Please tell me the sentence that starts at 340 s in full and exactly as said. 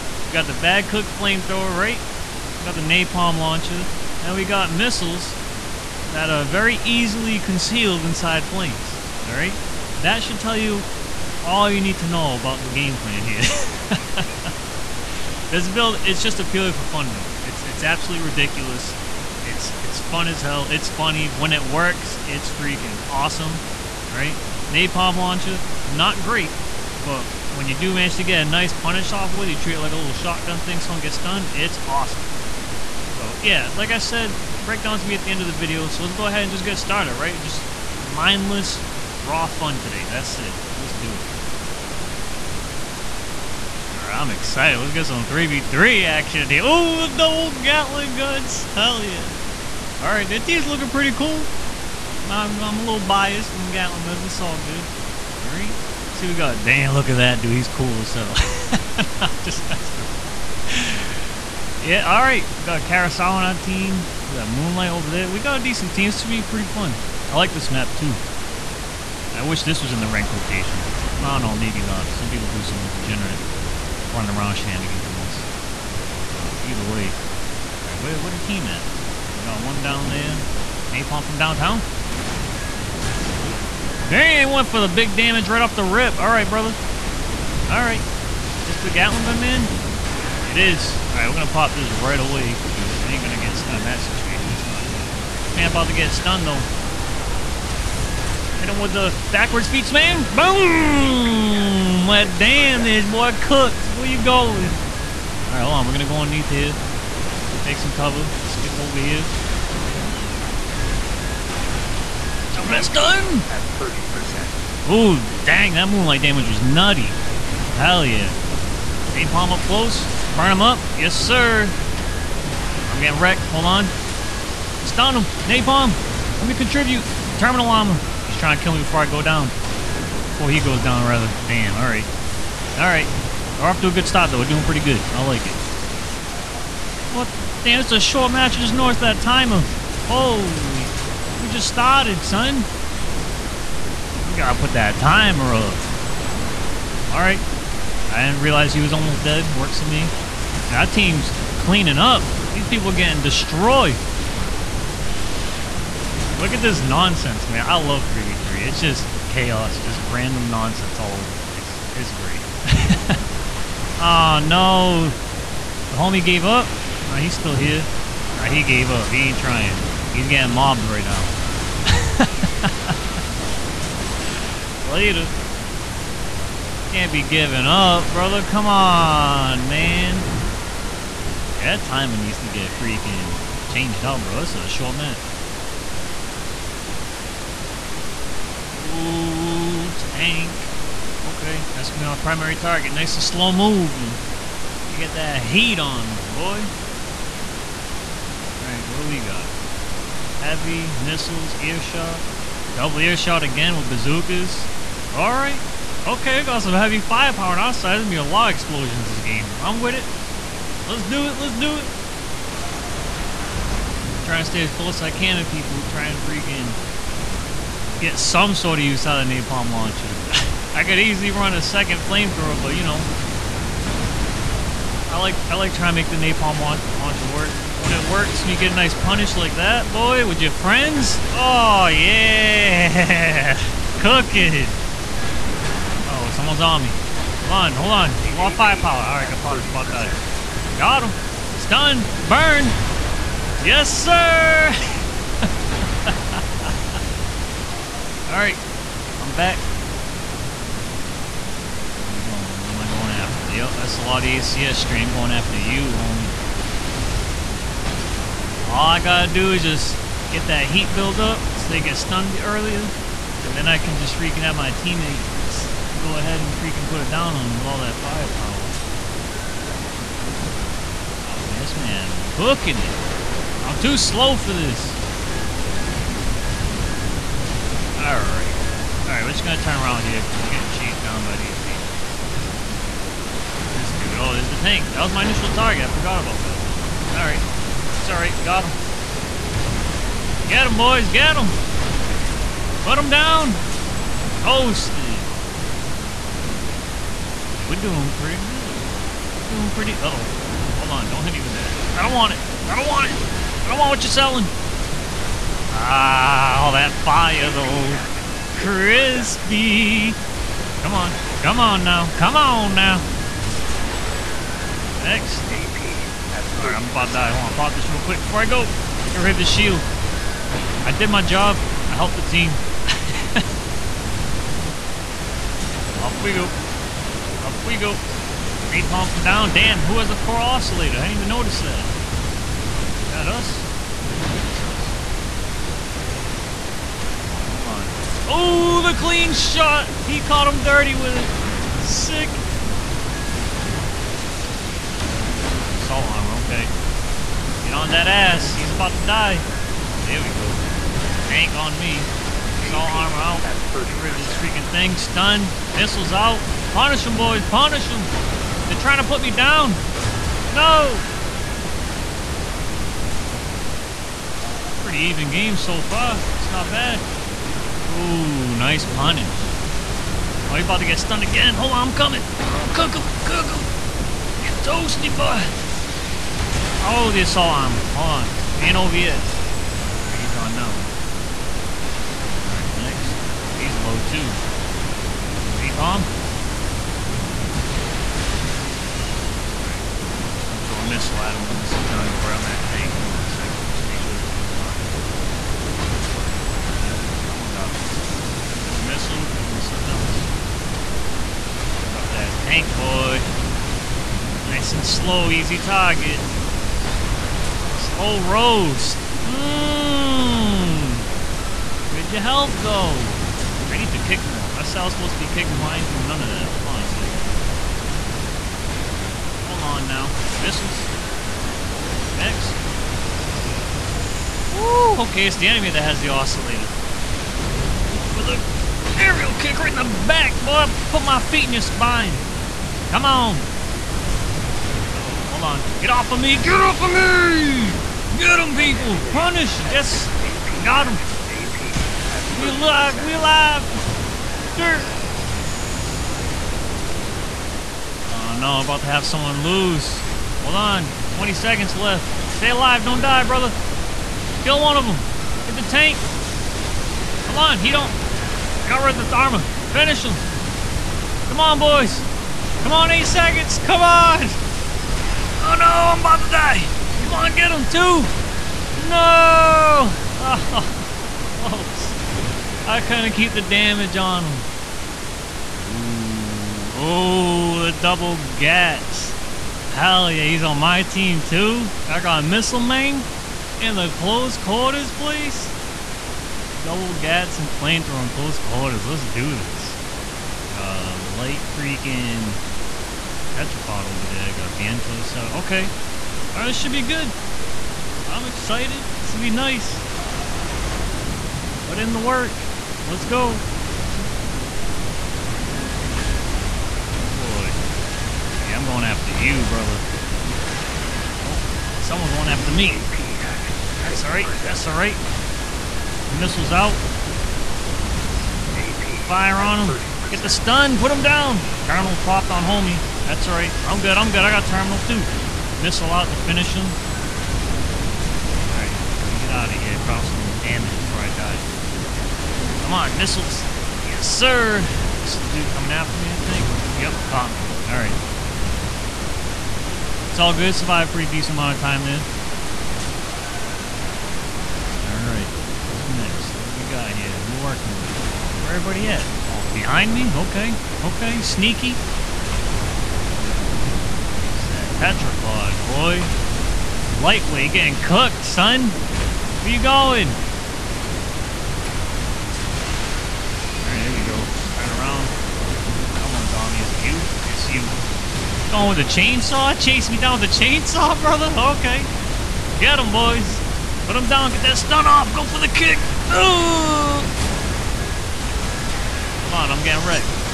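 He caught him dirty with it.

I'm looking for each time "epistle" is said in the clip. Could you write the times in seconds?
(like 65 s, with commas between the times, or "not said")
not said.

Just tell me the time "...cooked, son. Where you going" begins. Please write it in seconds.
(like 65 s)
557 s.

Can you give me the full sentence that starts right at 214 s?
Trying to stay as close as I can to people, trying to freaking get some sort of use out of napalm launcher.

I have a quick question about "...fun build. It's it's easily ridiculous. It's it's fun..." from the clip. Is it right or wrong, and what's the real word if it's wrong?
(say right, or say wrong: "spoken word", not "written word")
wrong: "absolutely", not "easily".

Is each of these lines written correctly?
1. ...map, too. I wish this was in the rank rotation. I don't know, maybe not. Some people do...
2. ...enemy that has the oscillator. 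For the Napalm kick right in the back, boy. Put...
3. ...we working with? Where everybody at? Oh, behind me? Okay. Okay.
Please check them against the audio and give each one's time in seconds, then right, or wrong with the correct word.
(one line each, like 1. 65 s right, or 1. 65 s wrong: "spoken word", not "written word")
1. 67 s right
2. 425 s wrong: "Aerial", not "Napalm"
3. 547 s right.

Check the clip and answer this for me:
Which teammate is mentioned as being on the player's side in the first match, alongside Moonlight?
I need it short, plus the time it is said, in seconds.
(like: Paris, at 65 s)
Carousel, at 62 s.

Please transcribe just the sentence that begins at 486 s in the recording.
Double gats and flamethrower on close quarters.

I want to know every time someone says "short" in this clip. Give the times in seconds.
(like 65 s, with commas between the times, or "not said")
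137 s, 184 s.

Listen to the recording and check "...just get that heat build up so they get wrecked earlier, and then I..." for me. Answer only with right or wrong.
wrong.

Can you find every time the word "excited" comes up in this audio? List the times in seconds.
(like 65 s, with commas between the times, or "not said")
44 s, 498 s.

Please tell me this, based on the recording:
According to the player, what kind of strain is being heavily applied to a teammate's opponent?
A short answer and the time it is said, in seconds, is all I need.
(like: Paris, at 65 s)
ACS strain, at 254 s.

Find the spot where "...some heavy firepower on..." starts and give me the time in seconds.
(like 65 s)
206 s.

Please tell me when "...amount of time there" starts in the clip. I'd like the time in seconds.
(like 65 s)
541 s.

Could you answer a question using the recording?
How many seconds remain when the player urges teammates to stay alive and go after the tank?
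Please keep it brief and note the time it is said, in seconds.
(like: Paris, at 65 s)
20, at 451 s.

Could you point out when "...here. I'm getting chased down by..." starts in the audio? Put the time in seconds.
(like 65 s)
280 s.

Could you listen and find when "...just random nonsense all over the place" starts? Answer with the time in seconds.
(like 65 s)
159 s.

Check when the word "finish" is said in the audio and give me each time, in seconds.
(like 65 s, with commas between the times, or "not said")
459 s, 526 s.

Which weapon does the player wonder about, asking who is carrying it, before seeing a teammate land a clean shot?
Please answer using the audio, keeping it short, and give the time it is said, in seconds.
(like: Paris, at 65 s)
Core oscillator, at 330 s.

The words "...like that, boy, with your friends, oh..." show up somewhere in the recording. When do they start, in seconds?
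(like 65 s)
229 s.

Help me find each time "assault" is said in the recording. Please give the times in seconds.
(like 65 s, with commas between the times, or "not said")
345 s, 352 s, 377 s.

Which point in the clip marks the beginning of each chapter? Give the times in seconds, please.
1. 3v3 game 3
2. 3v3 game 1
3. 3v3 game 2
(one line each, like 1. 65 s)
1. 474 s
2. 42 s
3. 185 s.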